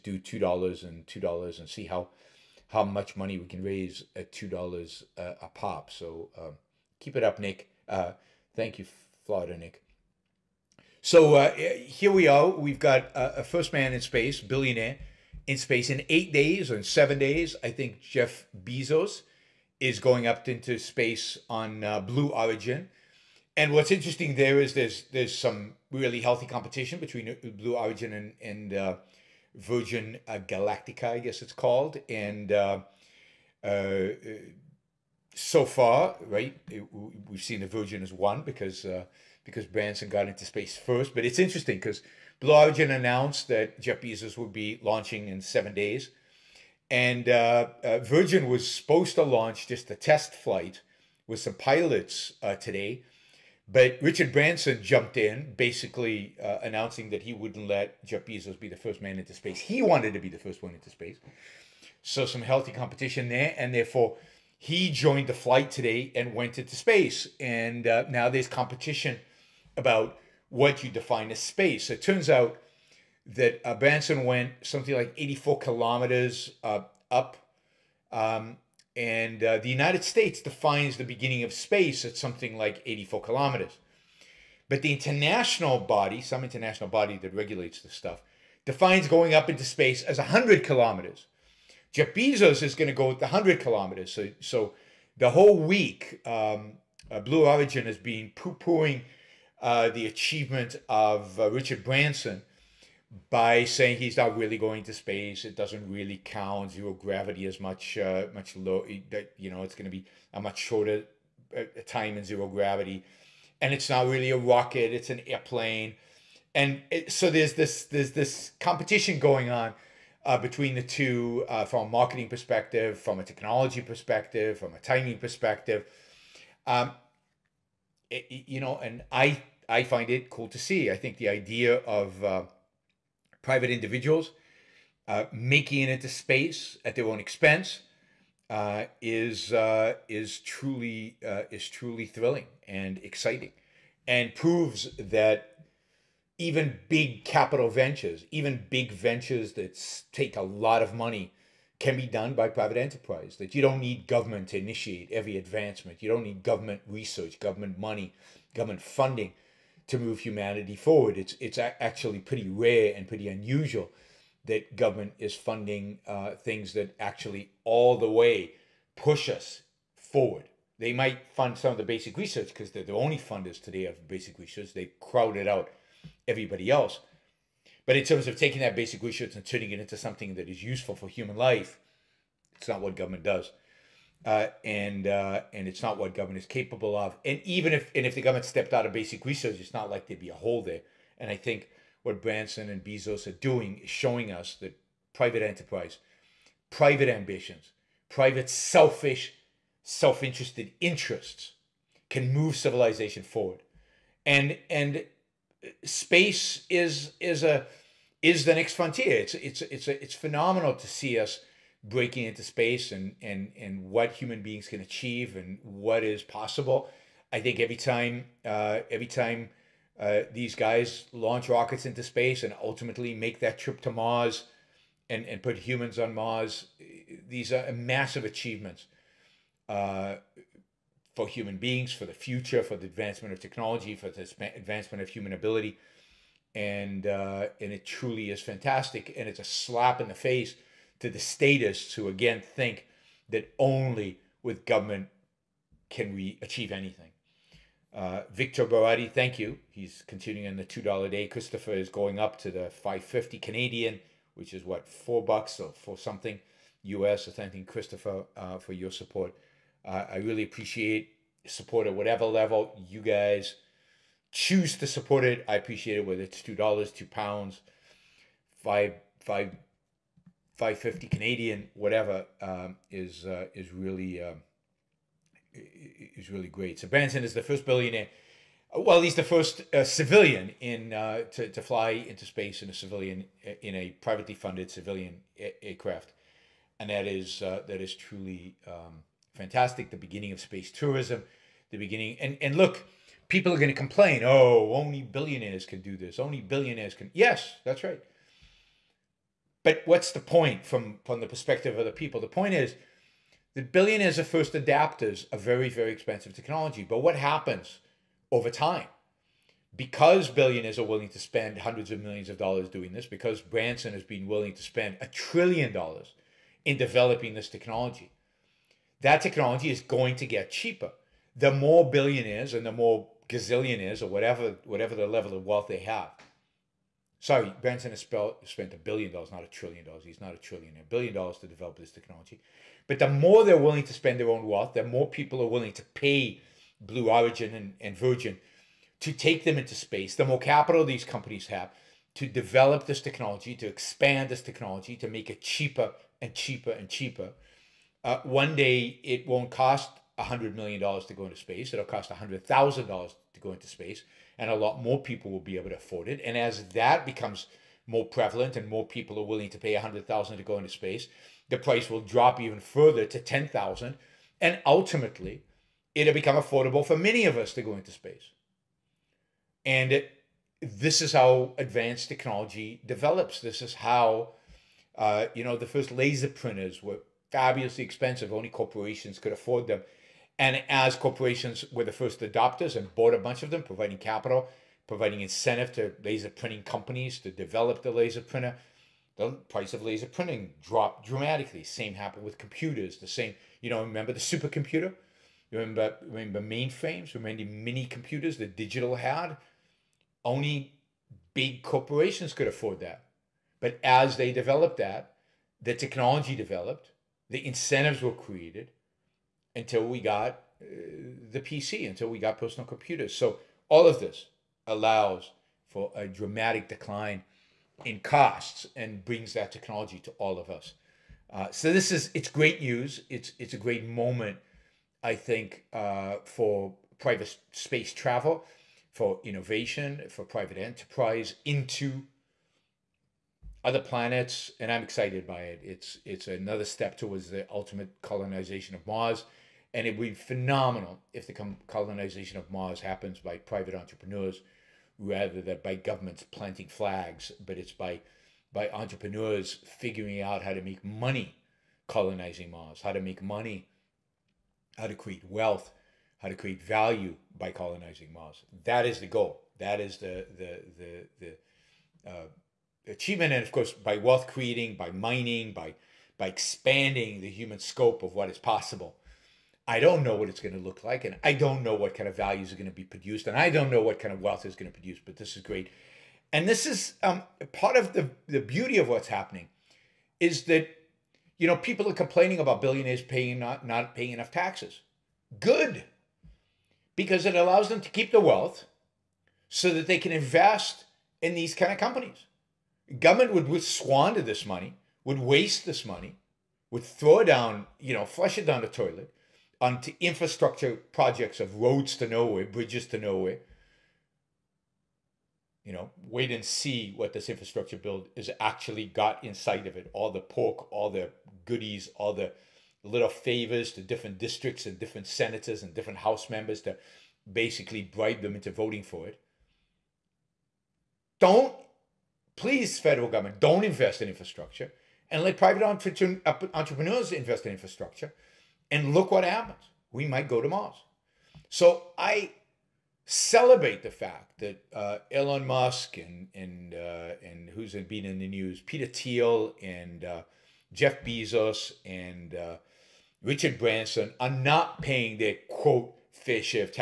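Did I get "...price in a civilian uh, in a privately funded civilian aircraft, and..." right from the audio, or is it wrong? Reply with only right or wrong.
wrong.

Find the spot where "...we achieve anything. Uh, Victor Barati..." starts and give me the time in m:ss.
4:06.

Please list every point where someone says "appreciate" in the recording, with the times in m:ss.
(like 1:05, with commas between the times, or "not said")
4:20, 4:25.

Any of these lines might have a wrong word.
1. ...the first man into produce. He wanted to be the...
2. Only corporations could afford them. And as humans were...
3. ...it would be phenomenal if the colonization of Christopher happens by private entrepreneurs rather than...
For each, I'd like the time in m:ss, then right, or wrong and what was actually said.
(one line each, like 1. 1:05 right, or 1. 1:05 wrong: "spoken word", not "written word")
1. 0:58 wrong: "space", not "produce"
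2. 6:18 wrong: "corporations", not "humans"
3. 7:19 wrong: "Mars", not "Christopher".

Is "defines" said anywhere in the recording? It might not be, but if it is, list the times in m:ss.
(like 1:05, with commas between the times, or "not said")
1:10, 1:20, 1:28.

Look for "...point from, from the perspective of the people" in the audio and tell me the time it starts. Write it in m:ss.
5:00.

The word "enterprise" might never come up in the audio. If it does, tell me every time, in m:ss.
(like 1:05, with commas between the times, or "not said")
2:32, 3:15, 7:10.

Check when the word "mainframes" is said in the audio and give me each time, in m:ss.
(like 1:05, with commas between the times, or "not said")
6:36.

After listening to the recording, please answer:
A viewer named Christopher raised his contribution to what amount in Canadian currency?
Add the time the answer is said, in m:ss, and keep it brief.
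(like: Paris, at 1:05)
5.50 Canadian, at 4:12.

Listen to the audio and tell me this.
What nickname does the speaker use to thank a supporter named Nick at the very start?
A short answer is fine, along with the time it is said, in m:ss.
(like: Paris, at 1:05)
Florida Nick, at 0:09.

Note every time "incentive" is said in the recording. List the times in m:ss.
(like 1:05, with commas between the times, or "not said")
6:25, 6:47.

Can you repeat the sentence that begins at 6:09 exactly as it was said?
And it, this is how advanced technology develops.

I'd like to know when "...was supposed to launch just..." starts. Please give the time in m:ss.
0:48.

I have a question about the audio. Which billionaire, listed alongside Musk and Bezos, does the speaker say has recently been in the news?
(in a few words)
Peter Thiel.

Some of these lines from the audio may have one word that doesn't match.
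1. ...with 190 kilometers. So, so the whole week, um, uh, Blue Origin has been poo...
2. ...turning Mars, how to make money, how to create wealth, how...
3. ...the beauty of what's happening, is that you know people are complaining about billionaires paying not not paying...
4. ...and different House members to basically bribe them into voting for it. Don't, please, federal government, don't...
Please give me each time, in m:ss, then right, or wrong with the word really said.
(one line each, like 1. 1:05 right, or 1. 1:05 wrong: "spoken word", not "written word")
1. 1:33 wrong: "100", not "190"
2. 7:31 wrong: "colonizing", not "turning"
3. 7:58 right
4. 8:35 right.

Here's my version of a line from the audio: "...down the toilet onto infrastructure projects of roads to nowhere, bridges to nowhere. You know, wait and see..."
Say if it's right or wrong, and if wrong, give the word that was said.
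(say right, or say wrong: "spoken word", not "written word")
right.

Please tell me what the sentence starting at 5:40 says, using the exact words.
The more capital these companies have to develop this technology, to expand this technology, to make it cheaper and cheaper and cheaper.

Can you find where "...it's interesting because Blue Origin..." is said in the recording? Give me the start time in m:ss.
0:41.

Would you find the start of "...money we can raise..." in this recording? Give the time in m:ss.
0:03.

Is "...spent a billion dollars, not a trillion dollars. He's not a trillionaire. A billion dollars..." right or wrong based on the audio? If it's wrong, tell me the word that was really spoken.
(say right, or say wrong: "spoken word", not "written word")
right.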